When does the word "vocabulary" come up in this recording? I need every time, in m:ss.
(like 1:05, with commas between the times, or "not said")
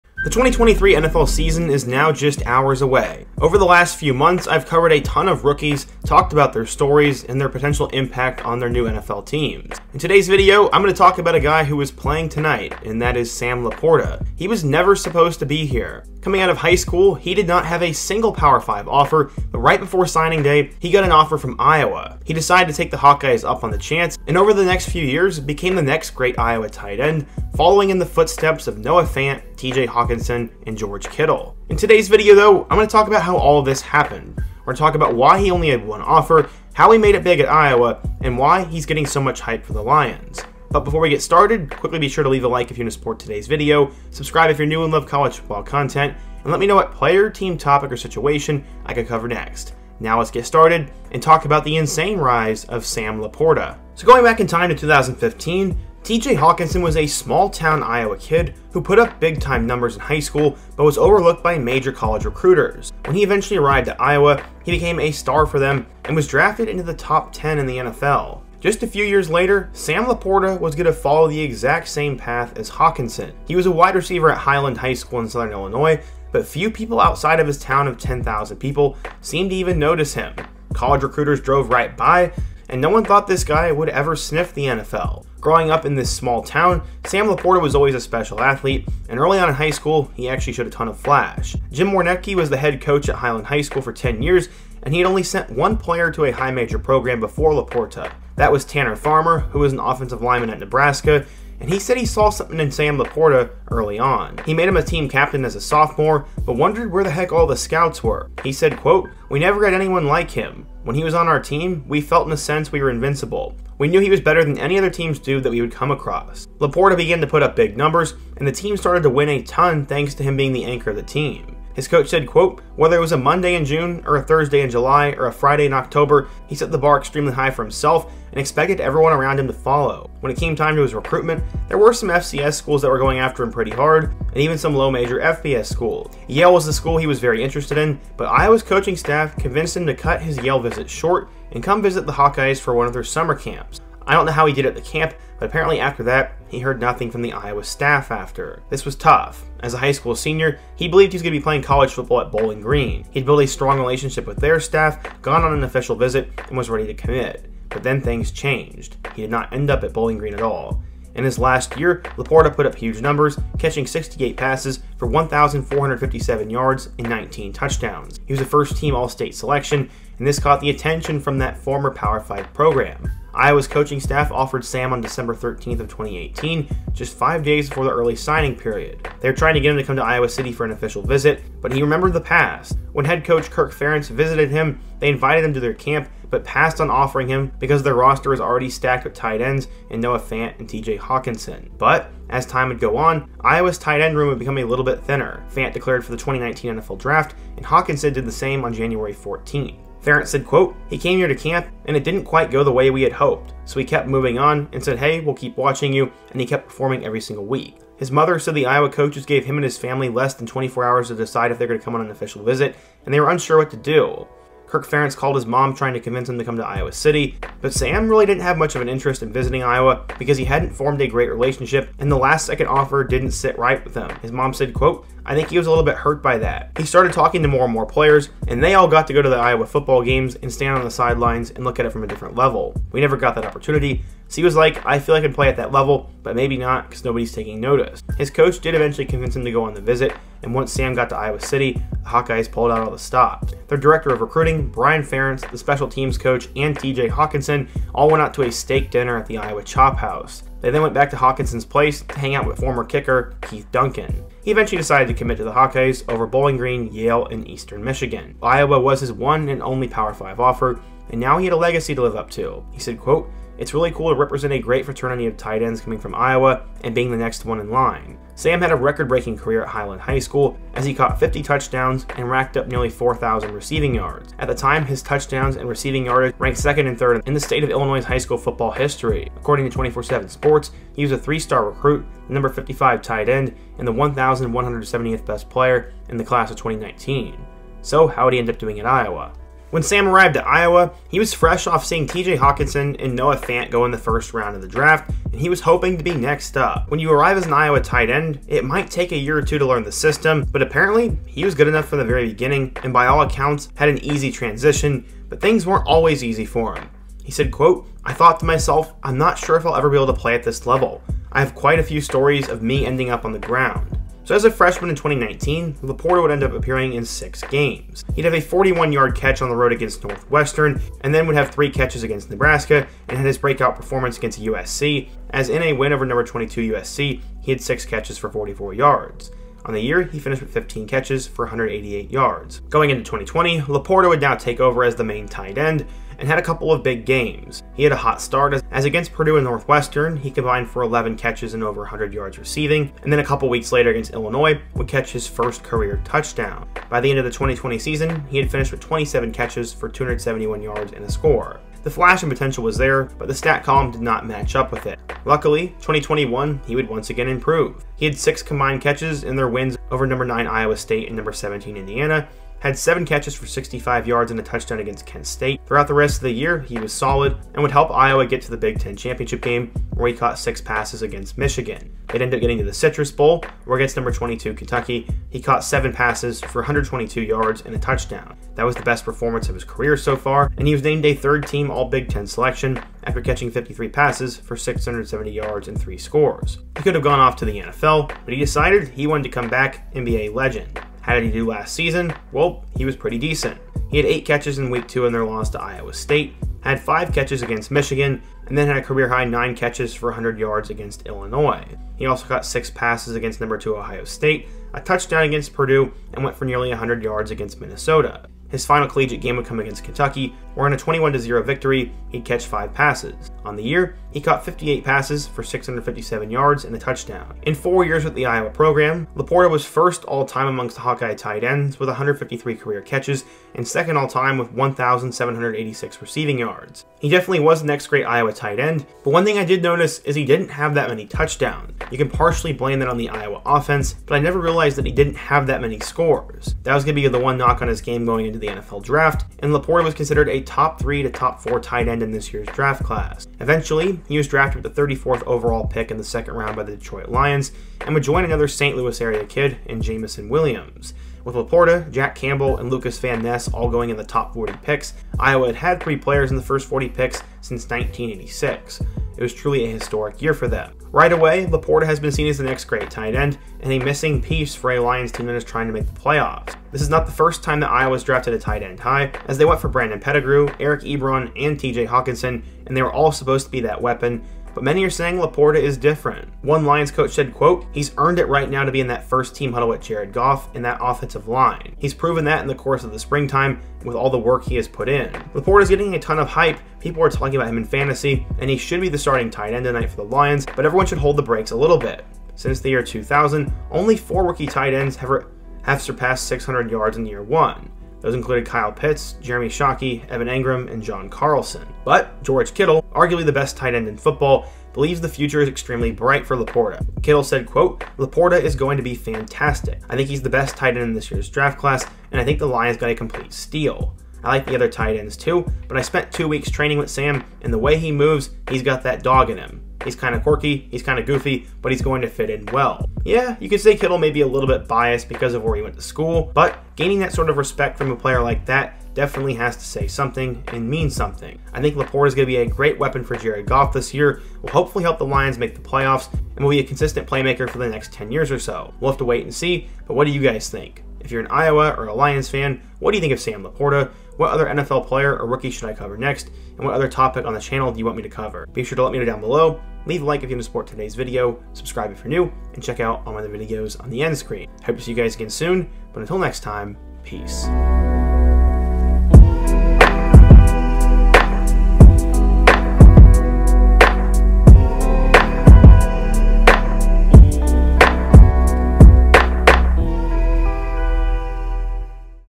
not said.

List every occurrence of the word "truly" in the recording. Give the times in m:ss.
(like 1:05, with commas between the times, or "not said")
7:39.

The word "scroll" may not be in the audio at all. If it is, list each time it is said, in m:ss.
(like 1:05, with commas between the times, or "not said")
not said.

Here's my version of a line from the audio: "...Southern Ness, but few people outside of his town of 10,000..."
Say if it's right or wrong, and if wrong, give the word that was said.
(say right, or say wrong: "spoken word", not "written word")
wrong: "Illinois", not "Ness".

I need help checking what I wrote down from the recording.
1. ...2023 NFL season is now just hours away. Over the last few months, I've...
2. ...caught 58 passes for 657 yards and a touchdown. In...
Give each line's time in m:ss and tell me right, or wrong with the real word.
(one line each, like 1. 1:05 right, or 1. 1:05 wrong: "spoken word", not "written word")
1. 0:00 right
2. 6:54 right.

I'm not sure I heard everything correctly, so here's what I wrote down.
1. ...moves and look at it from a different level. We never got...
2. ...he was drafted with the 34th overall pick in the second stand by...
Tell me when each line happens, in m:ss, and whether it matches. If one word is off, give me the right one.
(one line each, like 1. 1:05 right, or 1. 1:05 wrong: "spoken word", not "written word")
1. 3:50 wrong: "sidelines", not "moves"
2. 7:24 wrong: "round", not "stand".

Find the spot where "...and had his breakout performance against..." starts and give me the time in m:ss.
5:23.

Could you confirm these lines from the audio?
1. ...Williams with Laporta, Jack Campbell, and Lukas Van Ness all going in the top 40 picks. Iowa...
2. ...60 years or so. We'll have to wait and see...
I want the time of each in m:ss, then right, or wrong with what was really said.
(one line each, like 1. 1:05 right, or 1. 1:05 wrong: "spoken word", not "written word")
1. 7:30 right
2. 8:57 wrong: "10", not "60".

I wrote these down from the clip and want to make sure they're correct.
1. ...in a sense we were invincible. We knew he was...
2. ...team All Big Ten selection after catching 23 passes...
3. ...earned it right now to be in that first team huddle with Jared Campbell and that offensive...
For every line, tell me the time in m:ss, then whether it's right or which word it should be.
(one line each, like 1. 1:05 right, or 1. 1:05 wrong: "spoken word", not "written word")
1. 1:52 right
2. 6:21 wrong: "53", not "23"
3. 7:57 wrong: "Goff", not "Campbell".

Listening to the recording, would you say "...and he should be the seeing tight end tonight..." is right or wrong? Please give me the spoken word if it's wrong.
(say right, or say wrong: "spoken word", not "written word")
wrong: "starting", not "seeing".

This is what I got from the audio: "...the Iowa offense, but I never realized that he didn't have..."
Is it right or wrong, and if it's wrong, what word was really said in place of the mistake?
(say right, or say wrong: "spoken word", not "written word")
right.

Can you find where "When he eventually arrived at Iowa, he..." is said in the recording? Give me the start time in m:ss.
1:03.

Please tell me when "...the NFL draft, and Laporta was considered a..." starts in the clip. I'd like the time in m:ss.
7:18.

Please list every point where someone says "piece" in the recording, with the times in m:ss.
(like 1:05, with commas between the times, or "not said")
7:44.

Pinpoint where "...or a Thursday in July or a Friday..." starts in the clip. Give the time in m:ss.
2:04.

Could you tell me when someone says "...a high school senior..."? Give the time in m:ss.
2:29.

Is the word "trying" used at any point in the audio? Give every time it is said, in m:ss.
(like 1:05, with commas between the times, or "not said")
2:59, 3:35, 7:45.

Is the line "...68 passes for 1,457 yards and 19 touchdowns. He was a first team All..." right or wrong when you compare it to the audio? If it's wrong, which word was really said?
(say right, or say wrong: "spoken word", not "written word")
right.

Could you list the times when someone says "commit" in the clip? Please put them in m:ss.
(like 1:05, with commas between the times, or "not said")
2:36, 4:15.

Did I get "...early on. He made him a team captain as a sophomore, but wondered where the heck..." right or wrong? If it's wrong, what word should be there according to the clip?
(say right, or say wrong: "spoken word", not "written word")
right.